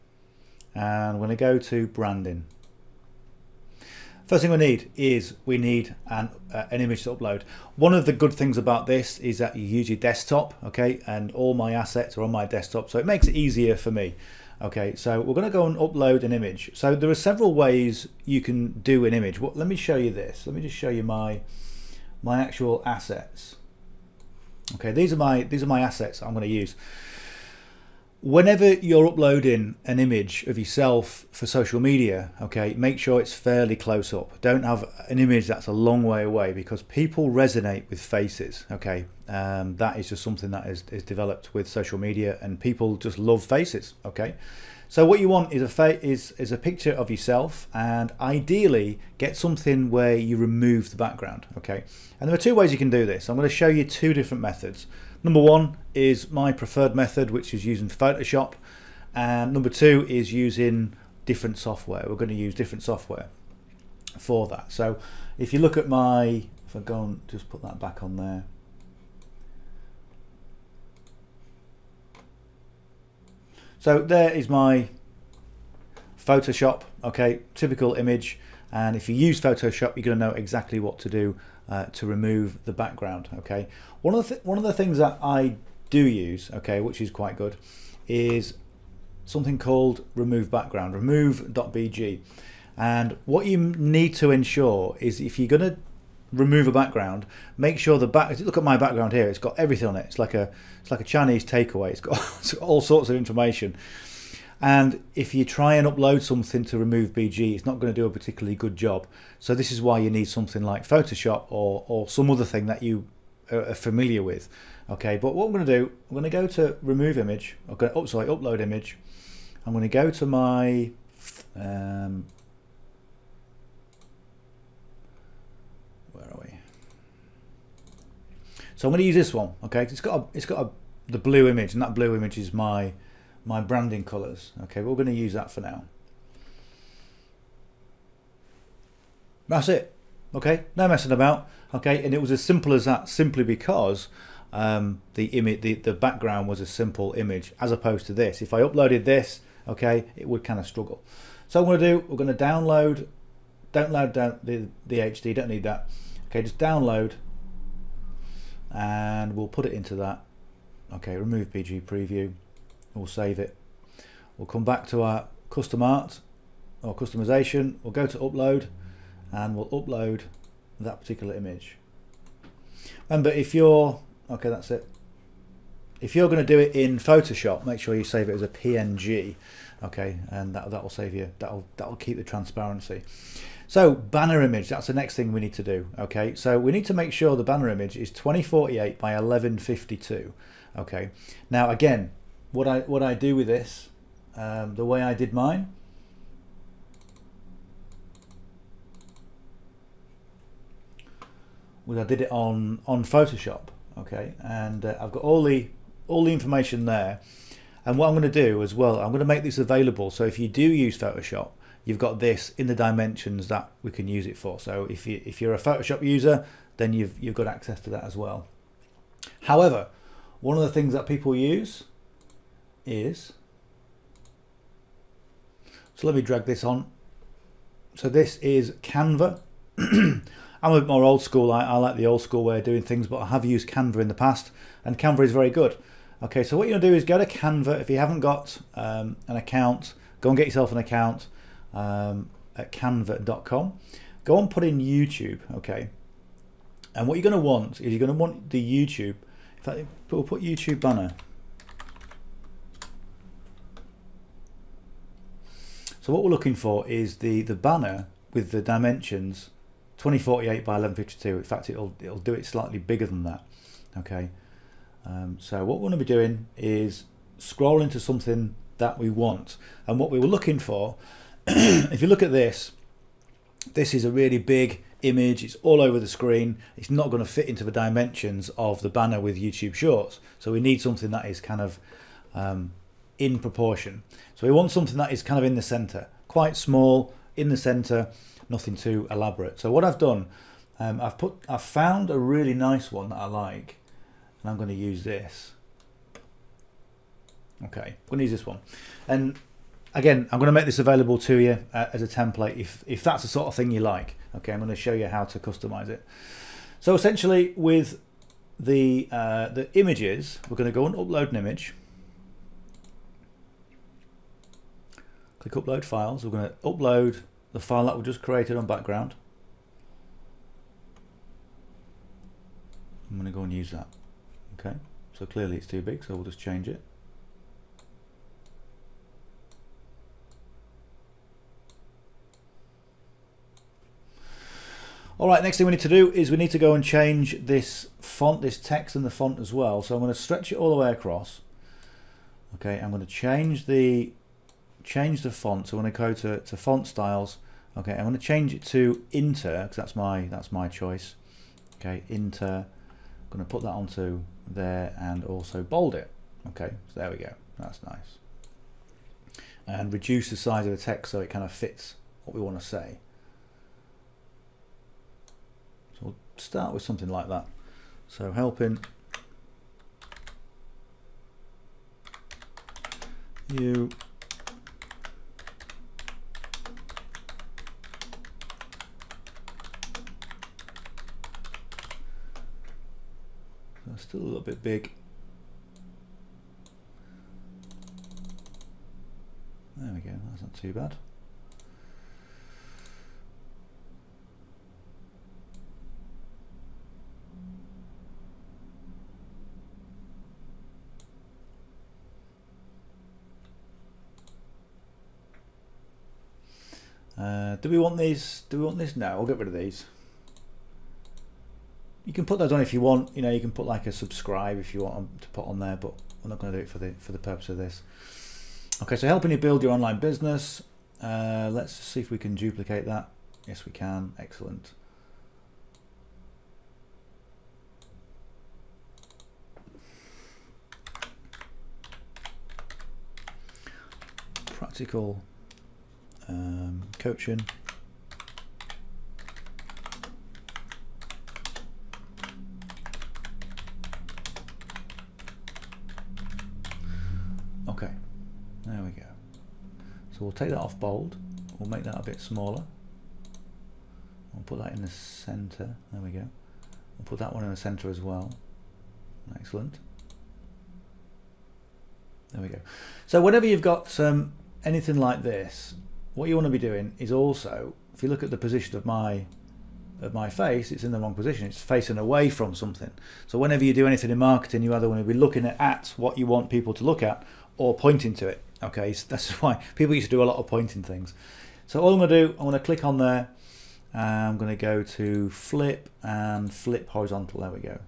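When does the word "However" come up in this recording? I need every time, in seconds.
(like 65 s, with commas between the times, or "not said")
219 s.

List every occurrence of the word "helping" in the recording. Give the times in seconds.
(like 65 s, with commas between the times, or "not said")
368 s, 419 s.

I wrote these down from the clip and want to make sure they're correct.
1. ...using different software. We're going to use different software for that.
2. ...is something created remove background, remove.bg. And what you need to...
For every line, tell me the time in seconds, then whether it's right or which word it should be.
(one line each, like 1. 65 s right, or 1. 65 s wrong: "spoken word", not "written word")
1. 60 s right
2. 88 s wrong: "called", not "created".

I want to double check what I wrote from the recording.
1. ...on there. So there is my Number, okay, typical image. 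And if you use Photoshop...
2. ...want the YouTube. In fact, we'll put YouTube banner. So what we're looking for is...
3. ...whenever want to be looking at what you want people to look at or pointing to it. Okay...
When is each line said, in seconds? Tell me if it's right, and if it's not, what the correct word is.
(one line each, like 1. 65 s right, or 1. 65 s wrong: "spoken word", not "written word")
1. 68 s wrong: "Photoshop", not "Number"
2. 248 s right
3. 474 s wrong: "either", not "whenever".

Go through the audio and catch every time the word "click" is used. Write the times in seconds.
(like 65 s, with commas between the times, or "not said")
315 s, 482 s.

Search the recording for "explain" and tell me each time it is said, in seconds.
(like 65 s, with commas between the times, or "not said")
not said.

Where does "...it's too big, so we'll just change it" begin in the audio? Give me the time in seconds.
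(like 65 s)
325 s.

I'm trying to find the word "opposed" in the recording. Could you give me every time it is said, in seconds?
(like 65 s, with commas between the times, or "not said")
147 s.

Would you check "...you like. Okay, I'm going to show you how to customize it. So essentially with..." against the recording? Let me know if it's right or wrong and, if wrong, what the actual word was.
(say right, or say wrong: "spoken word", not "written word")
right.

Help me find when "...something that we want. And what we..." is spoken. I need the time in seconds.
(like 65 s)
267 s.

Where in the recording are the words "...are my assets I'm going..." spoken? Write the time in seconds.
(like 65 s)
25 s.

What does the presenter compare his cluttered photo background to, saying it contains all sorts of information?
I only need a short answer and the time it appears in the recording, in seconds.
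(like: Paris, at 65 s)
A Chinese takeaway, at 101 s.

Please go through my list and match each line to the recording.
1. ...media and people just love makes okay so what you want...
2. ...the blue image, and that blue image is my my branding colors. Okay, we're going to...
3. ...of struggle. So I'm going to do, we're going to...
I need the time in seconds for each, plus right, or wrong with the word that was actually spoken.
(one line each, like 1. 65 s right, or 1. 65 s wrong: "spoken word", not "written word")
1. 41 s wrong: "faces", not "makes"
2. 131 s right
3. 150 s right.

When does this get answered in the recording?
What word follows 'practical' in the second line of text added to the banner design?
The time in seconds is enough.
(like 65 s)
437 s.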